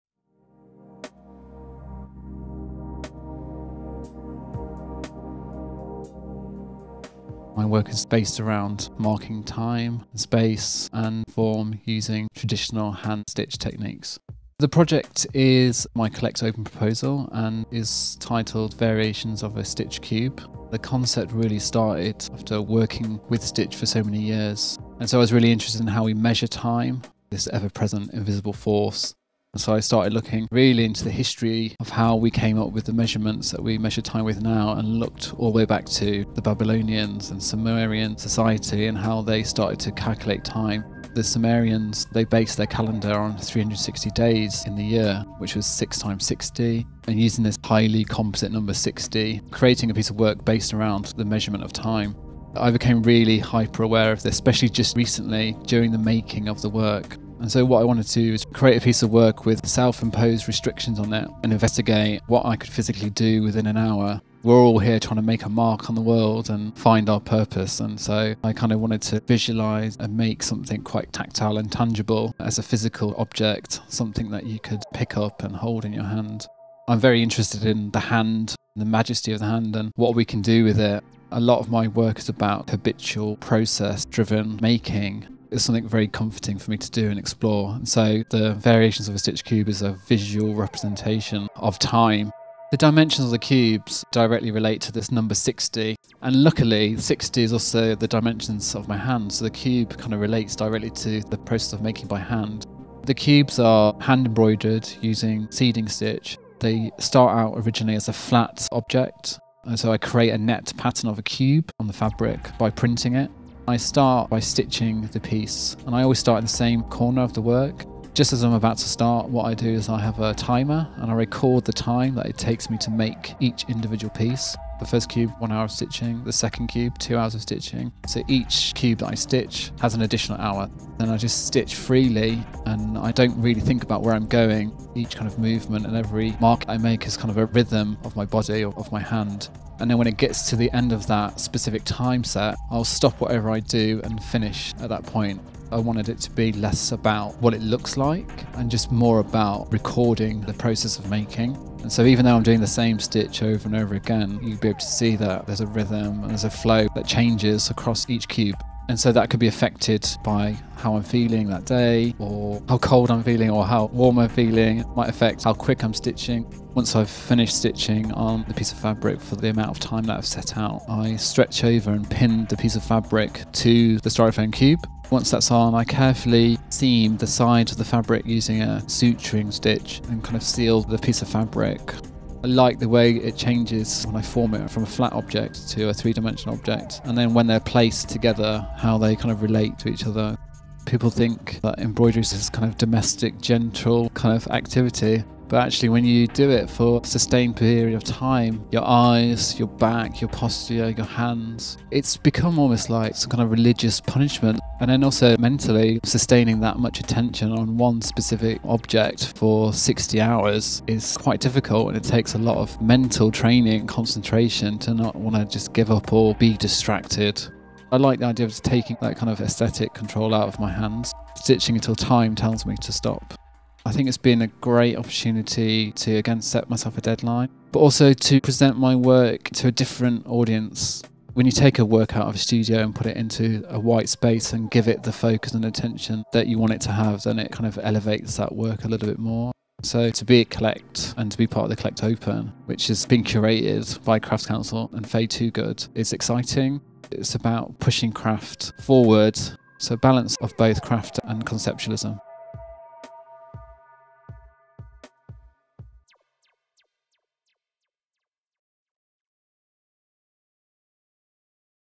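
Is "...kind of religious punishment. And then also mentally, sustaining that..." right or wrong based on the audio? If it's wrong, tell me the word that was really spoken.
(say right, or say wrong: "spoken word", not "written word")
right.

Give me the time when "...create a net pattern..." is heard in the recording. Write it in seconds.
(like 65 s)
109 s.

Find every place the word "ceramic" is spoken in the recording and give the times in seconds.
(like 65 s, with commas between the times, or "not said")
not said.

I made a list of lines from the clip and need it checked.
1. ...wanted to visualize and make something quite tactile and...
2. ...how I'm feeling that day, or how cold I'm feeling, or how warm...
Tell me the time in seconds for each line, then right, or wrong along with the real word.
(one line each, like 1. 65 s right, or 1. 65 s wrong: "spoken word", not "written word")
1. 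68 s right
2. 160 s right.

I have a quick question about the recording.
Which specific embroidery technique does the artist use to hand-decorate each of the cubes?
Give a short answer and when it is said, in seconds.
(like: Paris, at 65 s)
Seeding stitch, at 105 s.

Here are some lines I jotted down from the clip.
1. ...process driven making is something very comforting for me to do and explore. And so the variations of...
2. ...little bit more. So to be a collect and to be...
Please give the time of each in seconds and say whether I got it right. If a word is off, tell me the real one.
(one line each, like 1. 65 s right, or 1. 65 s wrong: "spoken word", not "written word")
1. 83 s right
2. 238 s right.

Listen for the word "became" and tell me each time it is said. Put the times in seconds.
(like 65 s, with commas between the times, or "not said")
52 s.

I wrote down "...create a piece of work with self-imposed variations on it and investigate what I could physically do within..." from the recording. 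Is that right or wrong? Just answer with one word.
wrong.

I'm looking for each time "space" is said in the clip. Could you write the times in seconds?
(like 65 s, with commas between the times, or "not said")
10 s, 234 s.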